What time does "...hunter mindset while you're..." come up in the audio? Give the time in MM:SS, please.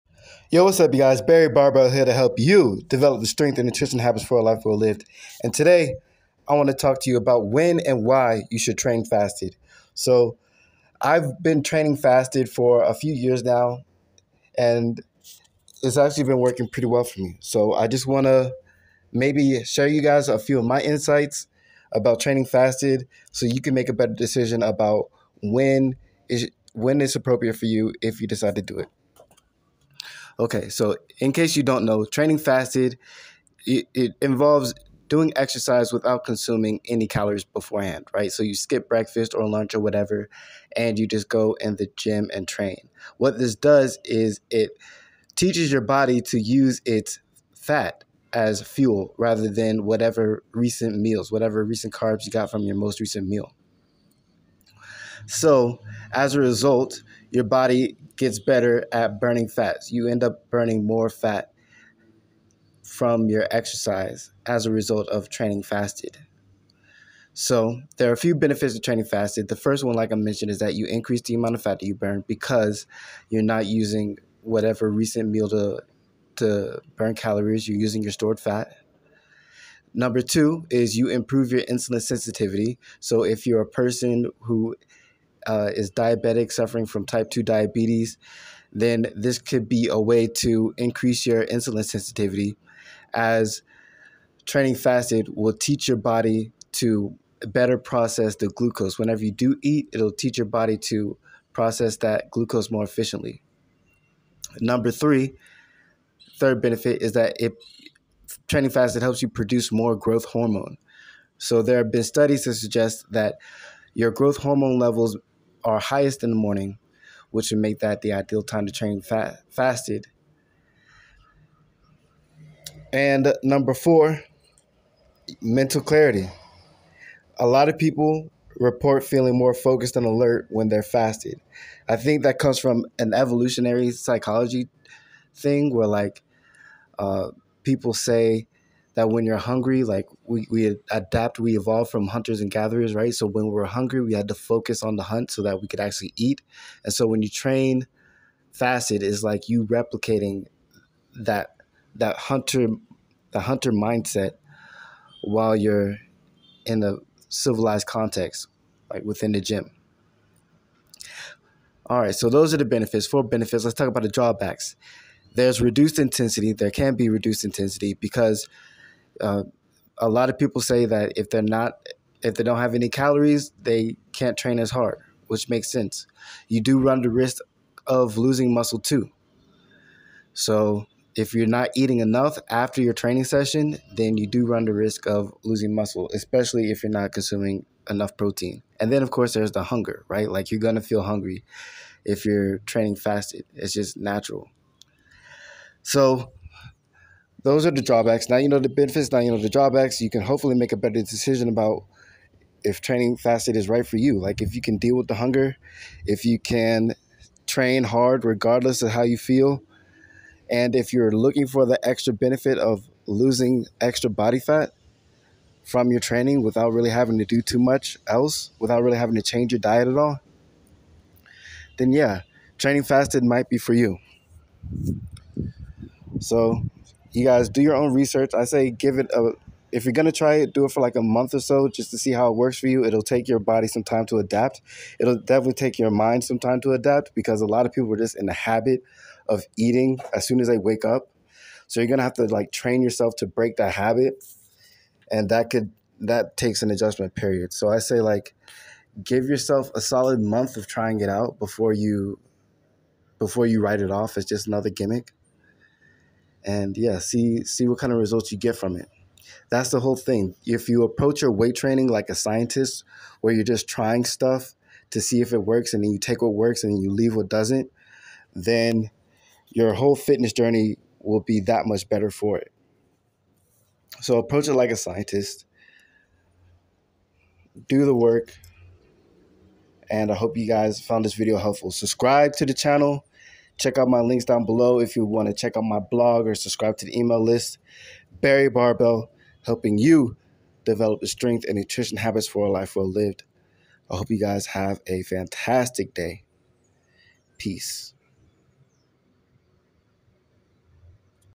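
02:33.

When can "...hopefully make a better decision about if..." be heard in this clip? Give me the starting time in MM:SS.
03:20.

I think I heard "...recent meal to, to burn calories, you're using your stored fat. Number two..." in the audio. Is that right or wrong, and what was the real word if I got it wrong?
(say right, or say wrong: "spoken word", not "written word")
right.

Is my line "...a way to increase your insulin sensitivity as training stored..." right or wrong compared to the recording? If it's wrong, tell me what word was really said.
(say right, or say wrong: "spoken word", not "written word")
wrong: "fasted", not "stored".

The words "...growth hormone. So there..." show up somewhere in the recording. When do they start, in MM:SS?
01:49.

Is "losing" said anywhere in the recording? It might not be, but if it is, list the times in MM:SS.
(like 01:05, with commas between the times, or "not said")
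02:58, 03:05, 03:33.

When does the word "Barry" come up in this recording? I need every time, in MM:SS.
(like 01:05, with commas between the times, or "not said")
00:01, 04:48.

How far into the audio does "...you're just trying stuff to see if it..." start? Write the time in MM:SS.
04:23.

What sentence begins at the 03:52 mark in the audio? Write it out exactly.
It'll take your body some time to adapt.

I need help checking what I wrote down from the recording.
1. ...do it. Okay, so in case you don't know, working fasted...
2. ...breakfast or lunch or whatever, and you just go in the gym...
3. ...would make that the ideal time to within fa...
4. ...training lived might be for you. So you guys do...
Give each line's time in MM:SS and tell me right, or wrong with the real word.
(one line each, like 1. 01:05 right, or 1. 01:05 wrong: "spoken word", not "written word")
1. 00:28 wrong: "training", not "working"
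2. 00:38 right
3. 01:57 wrong: "train", not "within"
4. 03:42 wrong: "fasted", not "lived".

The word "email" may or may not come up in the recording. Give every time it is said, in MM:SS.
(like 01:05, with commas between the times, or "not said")
04:46.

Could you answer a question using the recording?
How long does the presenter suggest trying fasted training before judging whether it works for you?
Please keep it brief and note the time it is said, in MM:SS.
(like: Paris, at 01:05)
a month, at 04:09.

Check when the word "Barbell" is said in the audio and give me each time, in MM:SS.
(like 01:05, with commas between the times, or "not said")
00:01, 04:48.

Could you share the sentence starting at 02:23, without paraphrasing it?
So when we're hungry, we had to focus on the hunt so that we could actually eat.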